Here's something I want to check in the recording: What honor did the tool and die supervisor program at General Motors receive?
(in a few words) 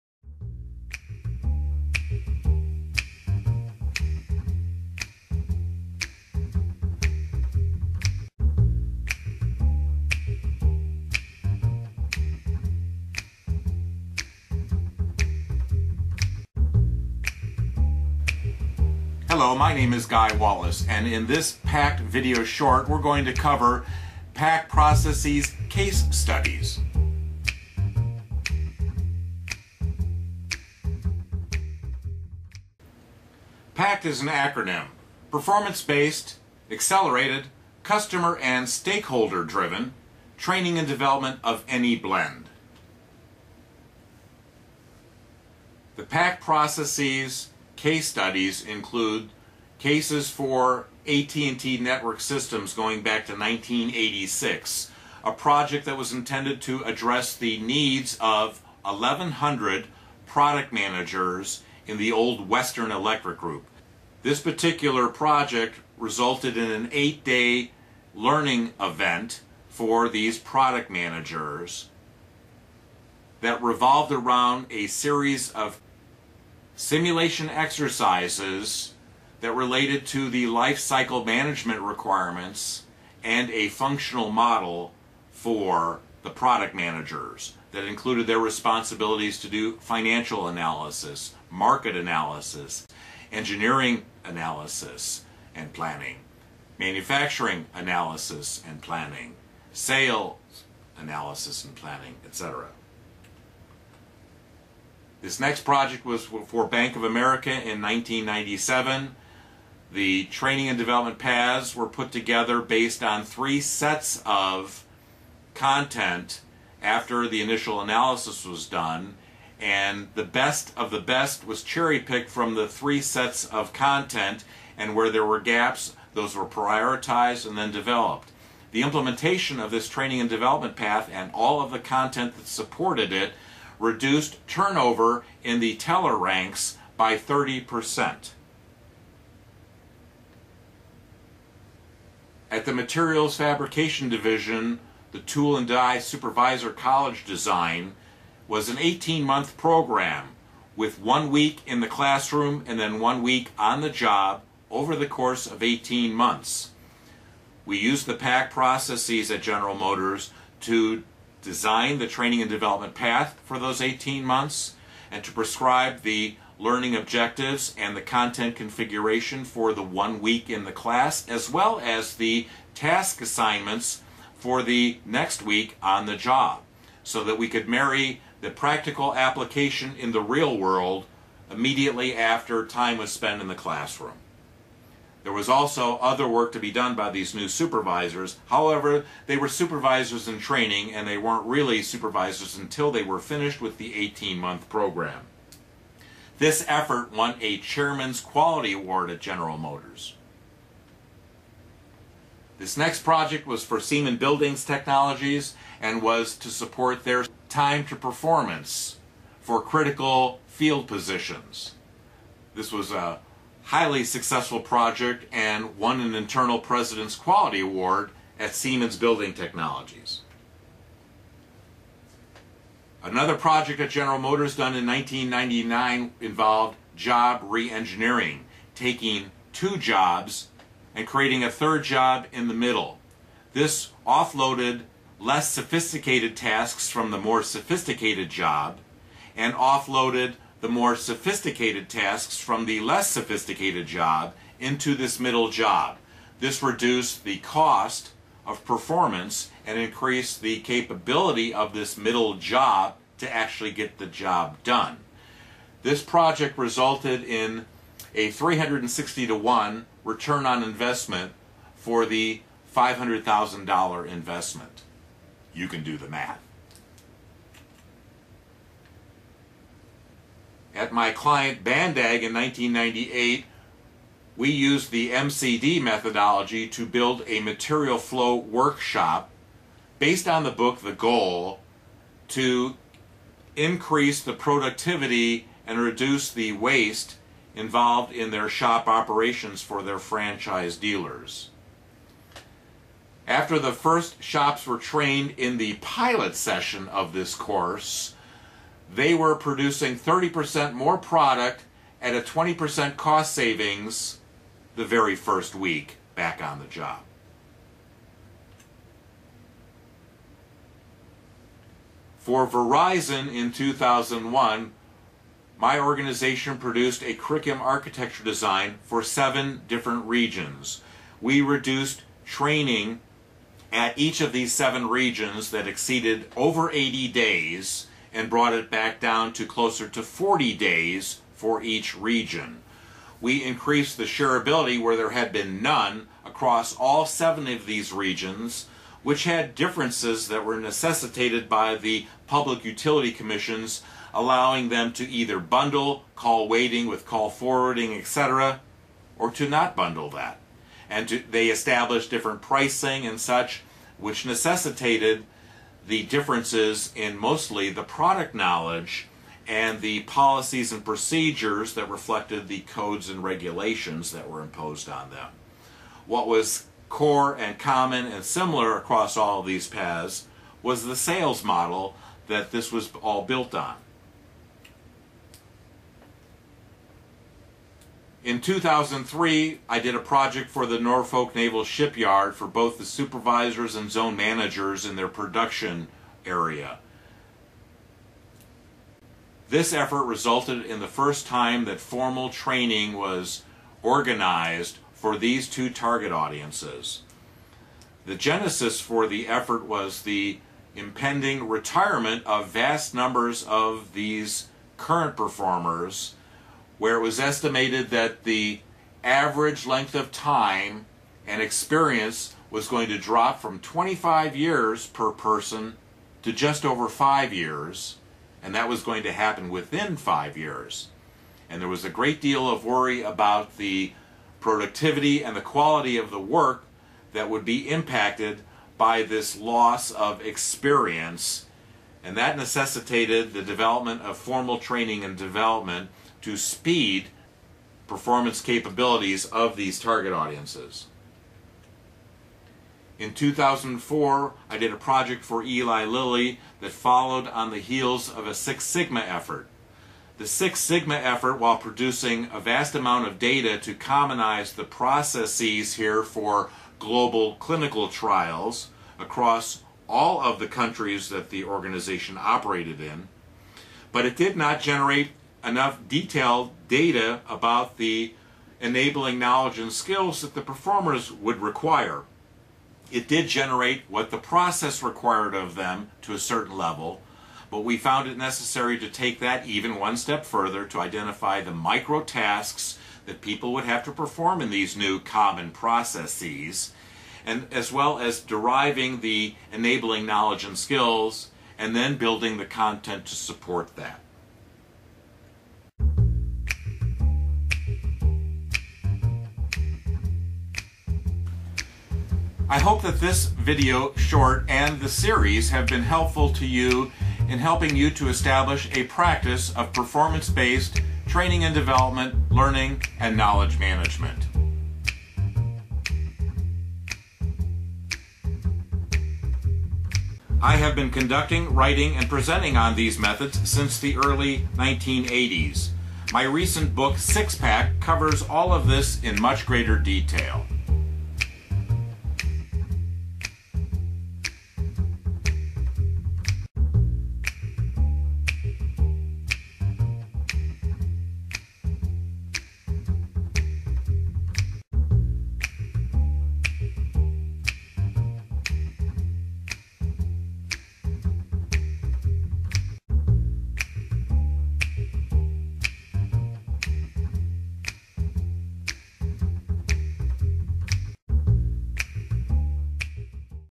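Chairman's Quality Award.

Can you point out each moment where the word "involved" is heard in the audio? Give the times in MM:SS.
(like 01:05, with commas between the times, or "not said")
03:46, 04:47.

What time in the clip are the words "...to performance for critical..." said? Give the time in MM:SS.
03:27.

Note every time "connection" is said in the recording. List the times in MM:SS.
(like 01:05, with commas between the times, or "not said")
not said.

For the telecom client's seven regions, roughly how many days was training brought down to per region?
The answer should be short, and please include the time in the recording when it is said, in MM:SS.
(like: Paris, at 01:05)
40 days, at 05:30.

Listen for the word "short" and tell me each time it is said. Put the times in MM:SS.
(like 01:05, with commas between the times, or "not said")
00:22, 08:23.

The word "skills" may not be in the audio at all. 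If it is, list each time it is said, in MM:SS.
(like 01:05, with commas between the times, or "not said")
07:49, 08:10.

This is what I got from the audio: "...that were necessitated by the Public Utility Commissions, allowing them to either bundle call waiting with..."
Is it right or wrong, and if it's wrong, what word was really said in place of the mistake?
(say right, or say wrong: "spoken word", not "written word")
right.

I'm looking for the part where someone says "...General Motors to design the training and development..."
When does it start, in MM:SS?
02:39.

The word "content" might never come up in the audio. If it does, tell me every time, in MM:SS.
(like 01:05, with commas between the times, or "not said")
01:55, 02:03, 02:11, 02:48, 08:12.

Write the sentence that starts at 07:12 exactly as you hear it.
And that necessitated the development of formal training and development to speed performance capabilities of these target audiences.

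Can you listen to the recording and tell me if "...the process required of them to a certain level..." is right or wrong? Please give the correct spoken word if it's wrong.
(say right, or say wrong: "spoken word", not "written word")
right.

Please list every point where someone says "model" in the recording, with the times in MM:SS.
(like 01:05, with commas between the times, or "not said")
01:24, 06:11.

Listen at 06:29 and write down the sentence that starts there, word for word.
This effort resulted in the first time that formal training was organized for these two target audiences.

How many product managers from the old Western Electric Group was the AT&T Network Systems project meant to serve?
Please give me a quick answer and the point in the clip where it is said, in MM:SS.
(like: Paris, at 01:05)
1,100, at 00:58.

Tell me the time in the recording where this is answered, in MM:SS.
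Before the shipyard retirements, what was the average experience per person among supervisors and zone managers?
06:53.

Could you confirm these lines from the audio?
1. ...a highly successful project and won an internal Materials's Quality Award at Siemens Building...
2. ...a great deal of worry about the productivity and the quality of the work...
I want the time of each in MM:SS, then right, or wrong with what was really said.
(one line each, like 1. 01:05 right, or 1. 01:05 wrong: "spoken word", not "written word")
1. 03:32 wrong: "President", not "Materials"
2. 07:01 right.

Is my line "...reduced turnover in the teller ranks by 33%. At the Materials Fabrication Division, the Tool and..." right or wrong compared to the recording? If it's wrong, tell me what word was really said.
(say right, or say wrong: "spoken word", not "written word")
wrong: "30", not "33".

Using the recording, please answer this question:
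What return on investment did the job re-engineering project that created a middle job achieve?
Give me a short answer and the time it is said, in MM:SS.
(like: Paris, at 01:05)
360 to 1, at 04:18.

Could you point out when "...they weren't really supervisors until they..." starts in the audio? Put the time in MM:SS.
03:11.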